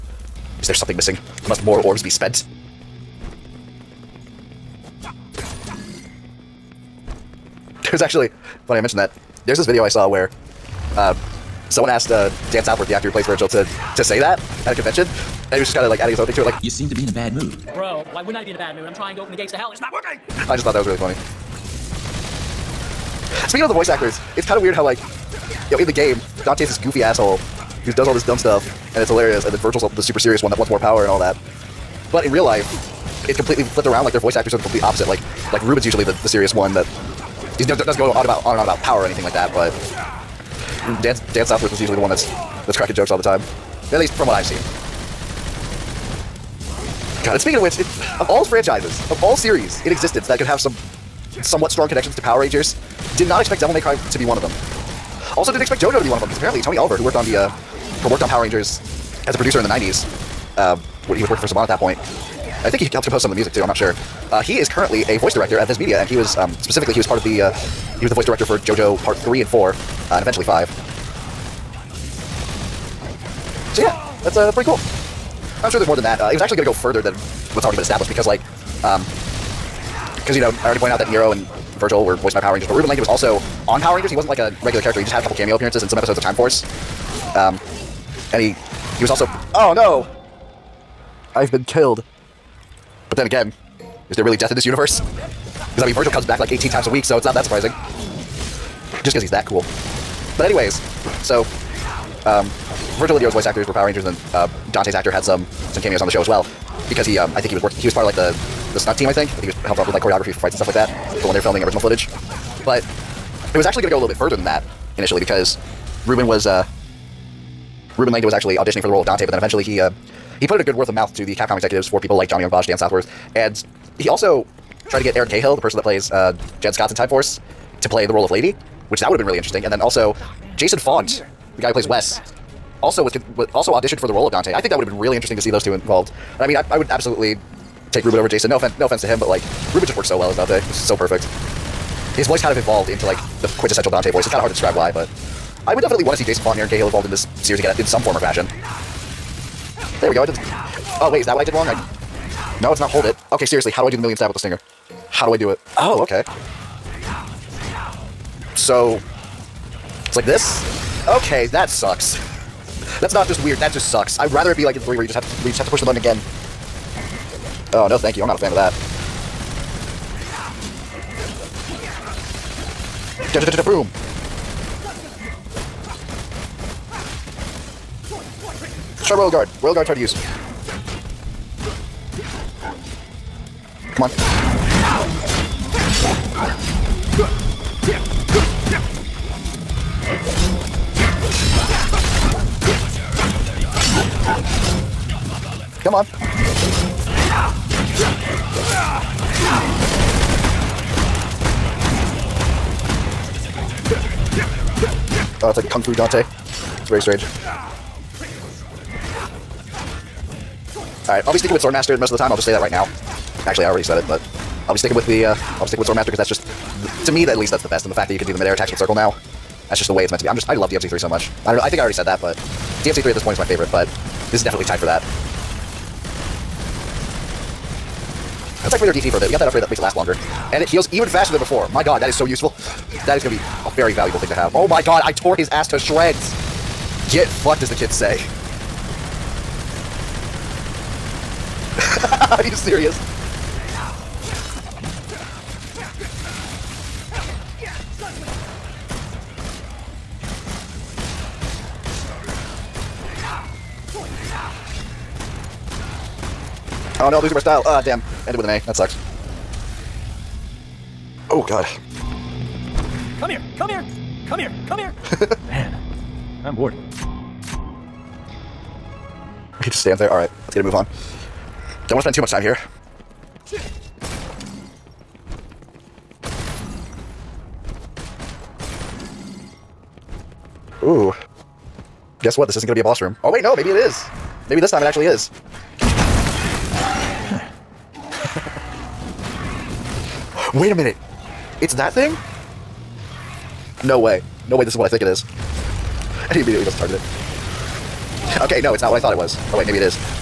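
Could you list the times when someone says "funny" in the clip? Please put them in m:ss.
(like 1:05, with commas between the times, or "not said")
0:08, 0:20.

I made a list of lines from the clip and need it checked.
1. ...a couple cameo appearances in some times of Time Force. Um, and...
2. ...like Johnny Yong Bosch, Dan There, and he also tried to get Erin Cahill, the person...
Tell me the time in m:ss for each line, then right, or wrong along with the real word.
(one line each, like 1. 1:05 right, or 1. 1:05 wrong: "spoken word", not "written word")
1. 1:25 wrong: "episodes", not "times"
2. 2:02 wrong: "Southworth", not "There".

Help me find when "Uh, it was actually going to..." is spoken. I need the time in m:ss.
1:16.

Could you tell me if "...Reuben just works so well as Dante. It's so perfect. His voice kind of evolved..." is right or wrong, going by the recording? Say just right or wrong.
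right.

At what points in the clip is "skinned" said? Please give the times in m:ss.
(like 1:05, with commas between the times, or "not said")
not said.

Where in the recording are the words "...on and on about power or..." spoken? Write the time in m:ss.
0:38.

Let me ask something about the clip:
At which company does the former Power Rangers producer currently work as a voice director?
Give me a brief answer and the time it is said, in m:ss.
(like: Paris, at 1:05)
Viz Media, at 1:05.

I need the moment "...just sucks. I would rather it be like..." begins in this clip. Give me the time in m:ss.
2:43.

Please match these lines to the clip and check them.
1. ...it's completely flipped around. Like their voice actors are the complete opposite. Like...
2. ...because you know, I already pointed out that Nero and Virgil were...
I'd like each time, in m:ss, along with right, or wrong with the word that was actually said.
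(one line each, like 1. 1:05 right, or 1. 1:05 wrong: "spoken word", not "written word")
1. 0:33 right
2. 1:20 right.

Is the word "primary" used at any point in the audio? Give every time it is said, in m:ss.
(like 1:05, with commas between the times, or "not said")
not said.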